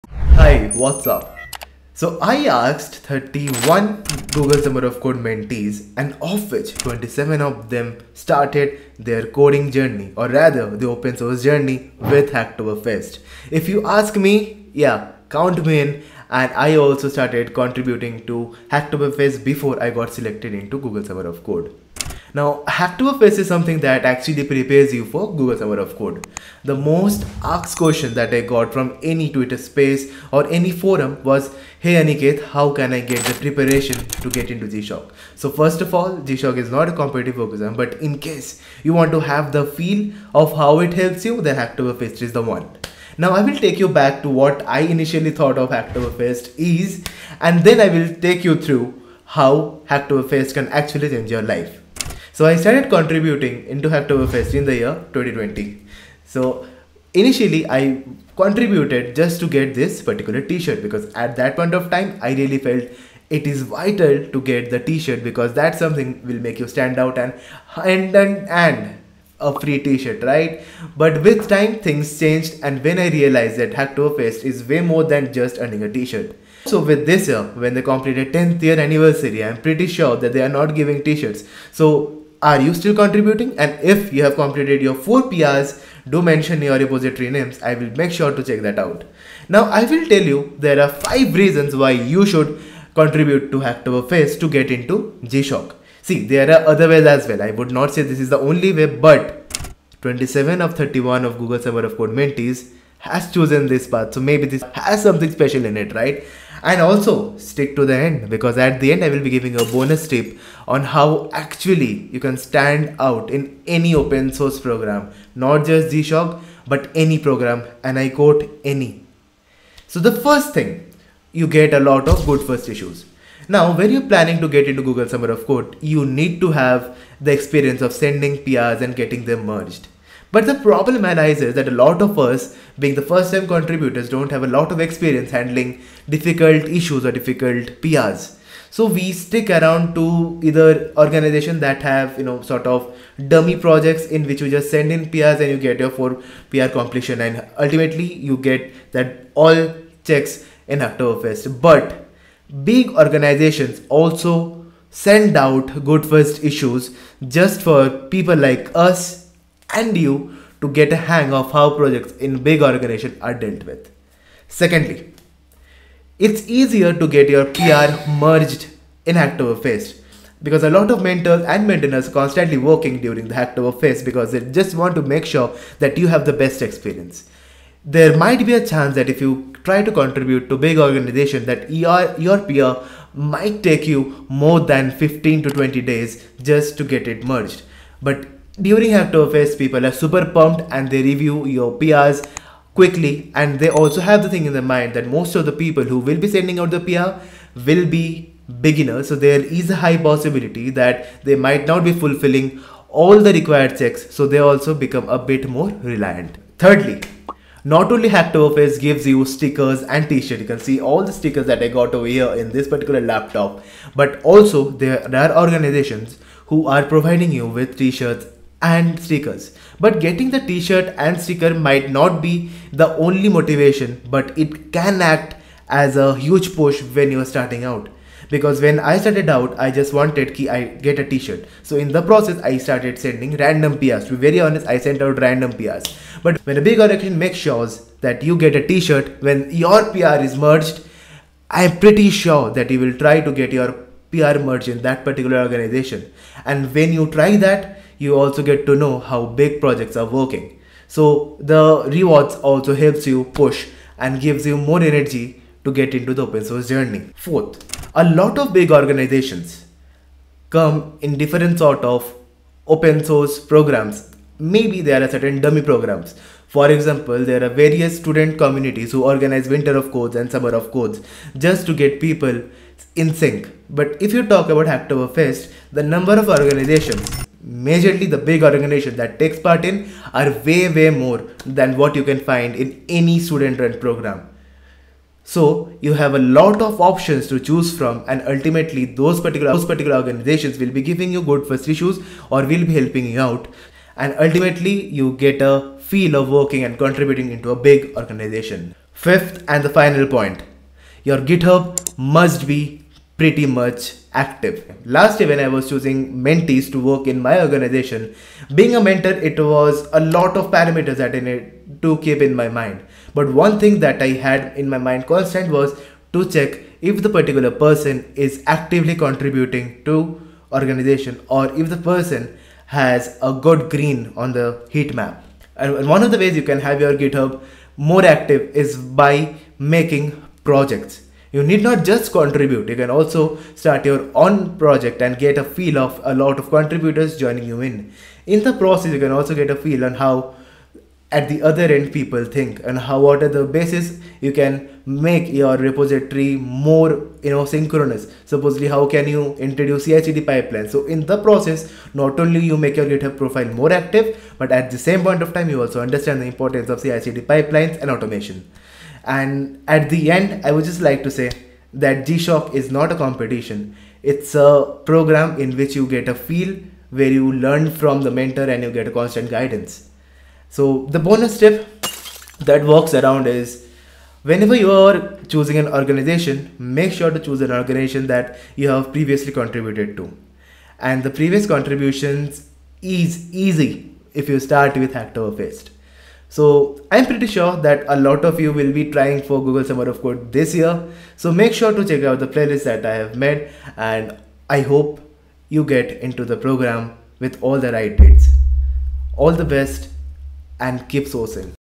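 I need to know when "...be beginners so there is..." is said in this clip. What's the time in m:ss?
3:17.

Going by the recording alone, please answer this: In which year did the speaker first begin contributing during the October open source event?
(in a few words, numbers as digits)
2020.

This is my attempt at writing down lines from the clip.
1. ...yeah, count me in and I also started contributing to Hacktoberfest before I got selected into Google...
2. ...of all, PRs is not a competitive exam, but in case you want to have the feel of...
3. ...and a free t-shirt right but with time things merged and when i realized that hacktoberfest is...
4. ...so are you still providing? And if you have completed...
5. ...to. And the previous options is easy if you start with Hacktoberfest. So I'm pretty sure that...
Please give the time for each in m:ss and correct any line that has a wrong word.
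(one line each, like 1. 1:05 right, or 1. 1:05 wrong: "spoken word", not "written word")
1. 0:14 right
2. 0:35 wrong: "GSoC", not "PRs"
3. 1:08 wrong: "changed", not "merged"
4. 1:21 wrong: "contributing", not "providing"
5. 6:19 wrong: "contributions", not "options".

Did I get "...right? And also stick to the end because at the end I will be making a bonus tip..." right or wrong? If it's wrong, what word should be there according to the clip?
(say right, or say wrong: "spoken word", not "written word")
wrong: "giving", not "making".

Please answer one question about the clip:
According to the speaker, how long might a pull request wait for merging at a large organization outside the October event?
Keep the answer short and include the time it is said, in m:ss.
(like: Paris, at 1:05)
15 to 20 days, at 3:04.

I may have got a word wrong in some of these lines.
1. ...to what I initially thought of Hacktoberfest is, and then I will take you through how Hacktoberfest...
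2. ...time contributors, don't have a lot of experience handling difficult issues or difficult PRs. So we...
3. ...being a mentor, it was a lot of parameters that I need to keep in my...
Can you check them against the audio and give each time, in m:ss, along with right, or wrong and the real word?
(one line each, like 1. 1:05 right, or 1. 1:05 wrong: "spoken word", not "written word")
1. 0:44 right
2. 2:13 right
3. 5:08 right.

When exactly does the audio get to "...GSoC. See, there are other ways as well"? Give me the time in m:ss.
1:35.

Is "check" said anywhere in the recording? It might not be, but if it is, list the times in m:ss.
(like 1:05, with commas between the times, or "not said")
1:28, 2:30, 3:23, 5:16, 6:31.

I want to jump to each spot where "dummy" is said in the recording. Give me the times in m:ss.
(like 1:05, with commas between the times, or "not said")
2:23, 4:25.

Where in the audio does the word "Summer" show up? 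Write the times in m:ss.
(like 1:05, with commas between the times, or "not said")
0:04, 0:21, 0:25, 1:41, 2:05, 4:30, 6:29.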